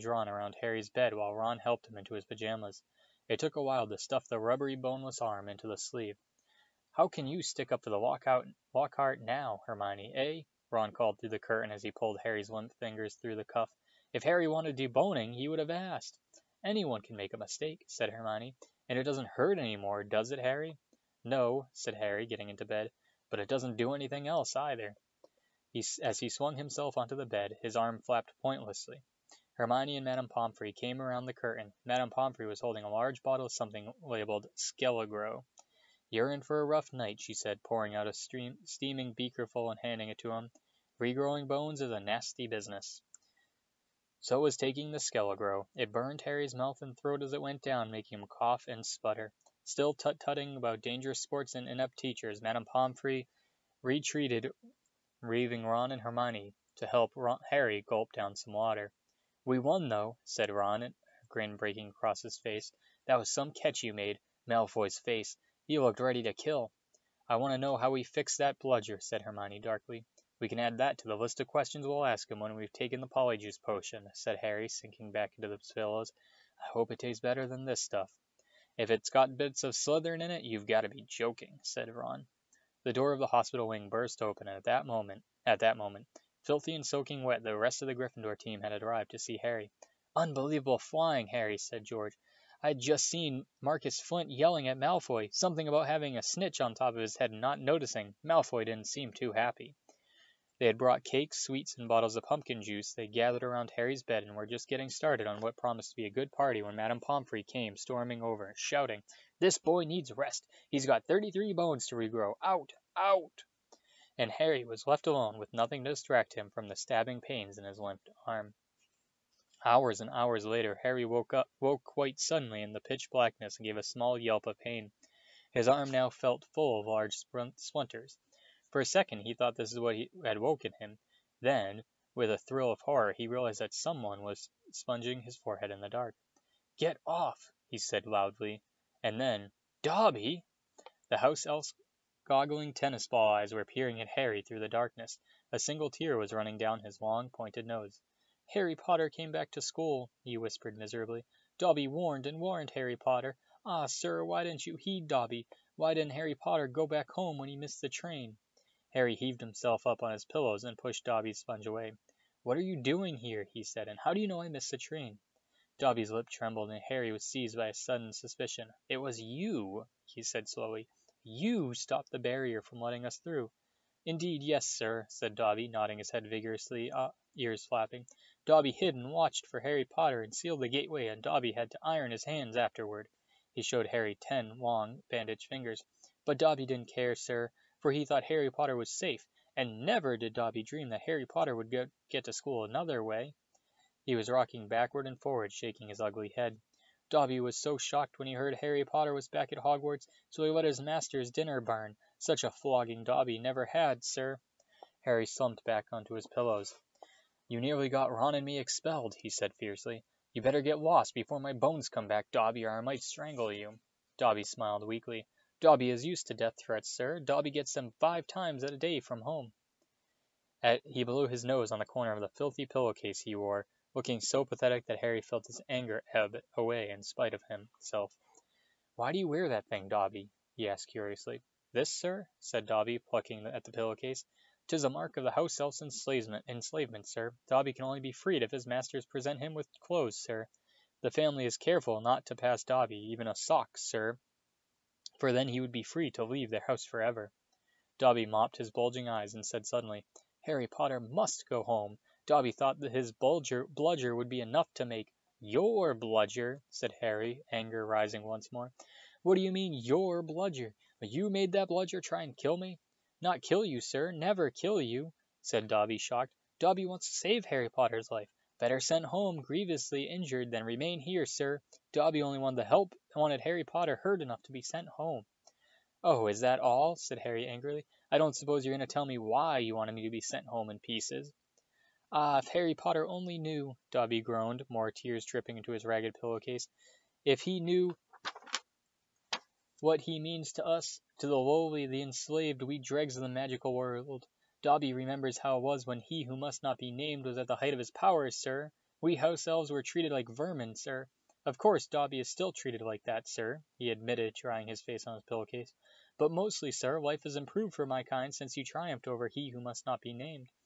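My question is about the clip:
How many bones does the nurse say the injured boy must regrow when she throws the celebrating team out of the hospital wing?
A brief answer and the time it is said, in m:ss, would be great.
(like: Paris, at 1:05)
33, at 1:51.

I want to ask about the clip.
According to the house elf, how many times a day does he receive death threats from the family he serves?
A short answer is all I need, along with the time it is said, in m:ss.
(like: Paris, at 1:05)
5, at 3:38.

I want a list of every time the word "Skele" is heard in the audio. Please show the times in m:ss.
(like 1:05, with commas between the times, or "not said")
0:34, 0:45.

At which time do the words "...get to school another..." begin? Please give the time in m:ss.
3:12.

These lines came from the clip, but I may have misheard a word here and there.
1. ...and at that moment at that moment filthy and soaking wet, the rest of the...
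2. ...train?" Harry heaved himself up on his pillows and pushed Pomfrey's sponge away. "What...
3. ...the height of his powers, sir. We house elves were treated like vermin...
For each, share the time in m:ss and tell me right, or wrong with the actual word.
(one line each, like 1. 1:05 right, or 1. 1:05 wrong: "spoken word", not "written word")
1. 1:24 right
2. 2:37 wrong: "Dobby", not "Pomfrey"
3. 4:57 right.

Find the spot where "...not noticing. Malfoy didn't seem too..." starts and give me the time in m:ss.
1:37.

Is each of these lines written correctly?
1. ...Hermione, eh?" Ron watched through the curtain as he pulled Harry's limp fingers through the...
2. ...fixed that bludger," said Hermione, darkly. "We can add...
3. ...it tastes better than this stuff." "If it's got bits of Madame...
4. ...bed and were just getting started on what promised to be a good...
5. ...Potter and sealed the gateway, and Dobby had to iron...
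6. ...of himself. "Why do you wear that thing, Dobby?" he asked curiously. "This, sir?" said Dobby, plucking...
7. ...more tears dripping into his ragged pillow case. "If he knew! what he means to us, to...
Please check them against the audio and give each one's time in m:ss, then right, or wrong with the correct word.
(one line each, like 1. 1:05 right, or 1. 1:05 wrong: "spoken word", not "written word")
1. 0:09 wrong: "called", not "watched"
2. 1:08 right
3. 1:16 wrong: "Slytherin", not "Madame"
4. 1:44 right
5. 2:59 right
6. 3:47 right
7. 4:44 right.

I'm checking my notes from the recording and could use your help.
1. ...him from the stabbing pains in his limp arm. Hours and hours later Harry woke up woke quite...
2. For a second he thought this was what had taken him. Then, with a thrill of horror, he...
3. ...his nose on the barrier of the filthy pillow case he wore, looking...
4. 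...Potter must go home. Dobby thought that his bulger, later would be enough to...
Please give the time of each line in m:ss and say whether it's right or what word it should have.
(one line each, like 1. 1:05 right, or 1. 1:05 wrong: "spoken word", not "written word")
1. 1:56 right
2. 2:08 wrong: "woken", not "taken"
3. 3:41 wrong: "corner", not "barrier"
4. 4:10 wrong: "bludger", not "later".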